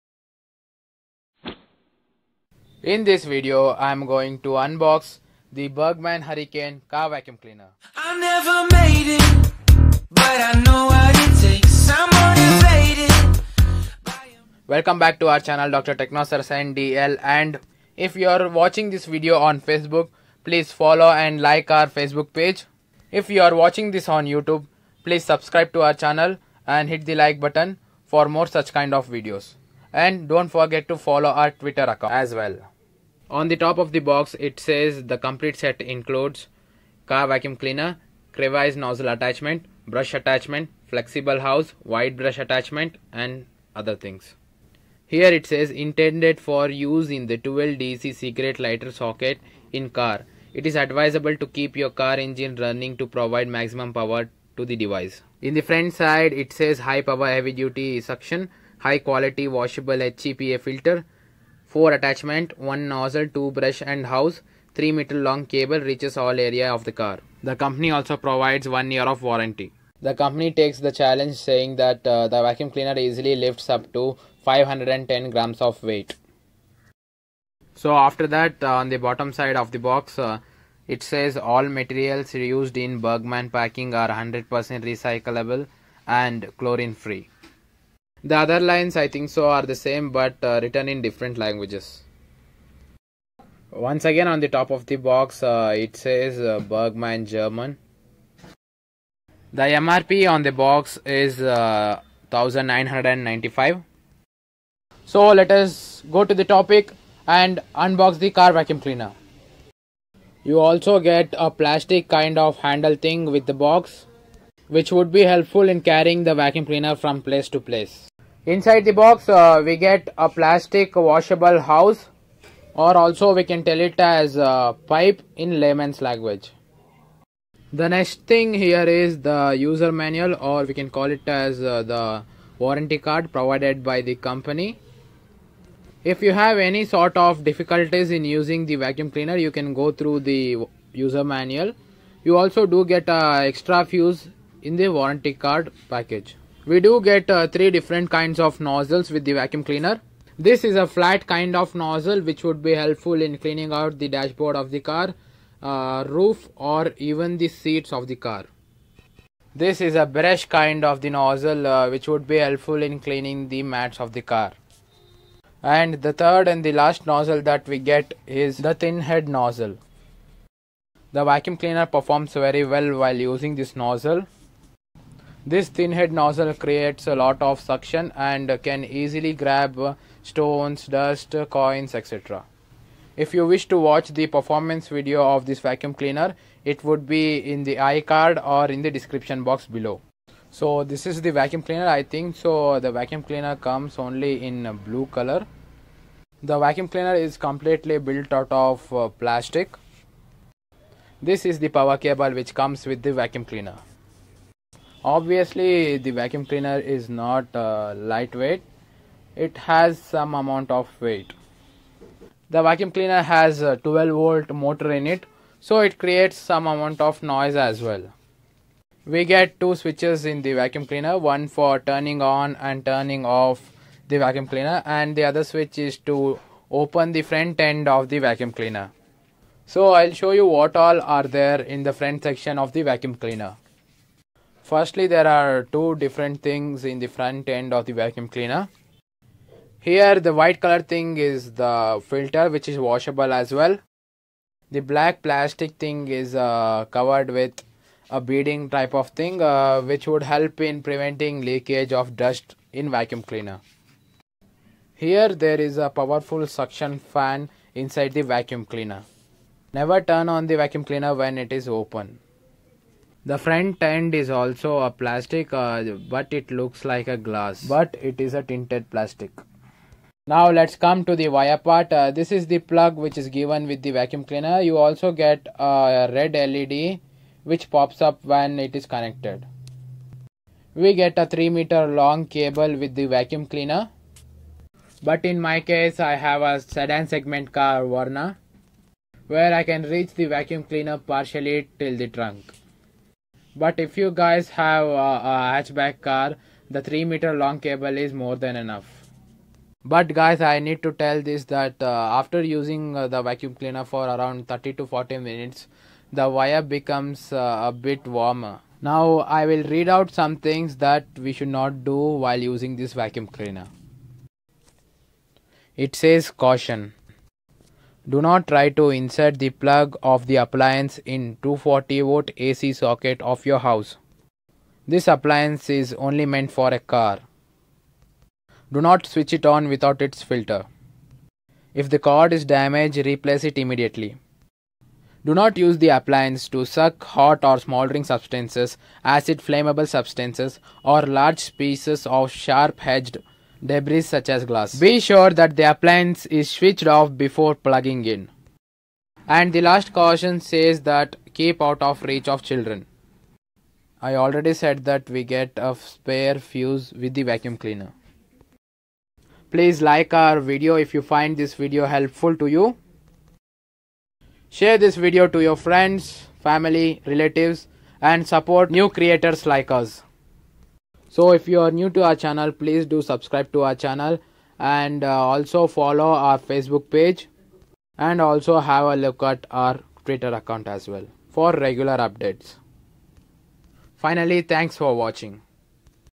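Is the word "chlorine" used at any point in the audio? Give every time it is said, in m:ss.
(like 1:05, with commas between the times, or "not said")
1:26.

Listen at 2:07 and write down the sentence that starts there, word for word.
The next thing here is the user manual or we can call it as uh, the warranty card provided by the company.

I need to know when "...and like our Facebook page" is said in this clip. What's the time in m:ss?
0:21.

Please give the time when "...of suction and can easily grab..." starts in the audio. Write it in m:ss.
2:57.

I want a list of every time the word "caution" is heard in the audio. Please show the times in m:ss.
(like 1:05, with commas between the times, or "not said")
5:16, 5:49.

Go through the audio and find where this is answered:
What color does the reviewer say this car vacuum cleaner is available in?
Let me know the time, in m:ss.
3:14.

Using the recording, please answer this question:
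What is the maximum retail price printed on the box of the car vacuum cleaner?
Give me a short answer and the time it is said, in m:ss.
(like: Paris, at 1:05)
1995, at 1:41.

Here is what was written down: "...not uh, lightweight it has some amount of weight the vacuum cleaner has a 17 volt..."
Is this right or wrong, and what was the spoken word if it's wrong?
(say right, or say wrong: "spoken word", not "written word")
wrong: "12", not "17".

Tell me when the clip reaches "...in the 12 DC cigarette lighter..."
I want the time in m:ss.
0:47.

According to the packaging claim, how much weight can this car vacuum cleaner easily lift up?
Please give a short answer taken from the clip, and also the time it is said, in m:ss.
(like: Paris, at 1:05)
510 grams, at 1:14.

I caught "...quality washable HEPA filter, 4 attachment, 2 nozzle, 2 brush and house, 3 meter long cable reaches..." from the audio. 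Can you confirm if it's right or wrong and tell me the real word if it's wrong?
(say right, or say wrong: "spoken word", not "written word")
wrong: "1", not "2".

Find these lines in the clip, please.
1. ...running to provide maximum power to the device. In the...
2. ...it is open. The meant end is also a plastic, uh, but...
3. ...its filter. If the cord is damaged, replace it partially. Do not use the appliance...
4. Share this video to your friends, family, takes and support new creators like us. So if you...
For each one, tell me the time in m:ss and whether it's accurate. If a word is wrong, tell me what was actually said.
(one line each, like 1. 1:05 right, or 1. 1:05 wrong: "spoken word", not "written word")
1. 0:52 right
2. 4:21 wrong: "front", not "meant"
3. 5:30 wrong: "immediately", not "partially"
4. 6:04 wrong: "relatives", not "takes".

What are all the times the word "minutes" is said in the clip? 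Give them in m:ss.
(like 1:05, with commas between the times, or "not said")
5:05.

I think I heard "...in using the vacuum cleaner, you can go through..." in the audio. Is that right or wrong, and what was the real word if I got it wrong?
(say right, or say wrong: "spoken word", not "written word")
right.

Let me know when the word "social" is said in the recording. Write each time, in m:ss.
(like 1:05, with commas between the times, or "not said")
not said.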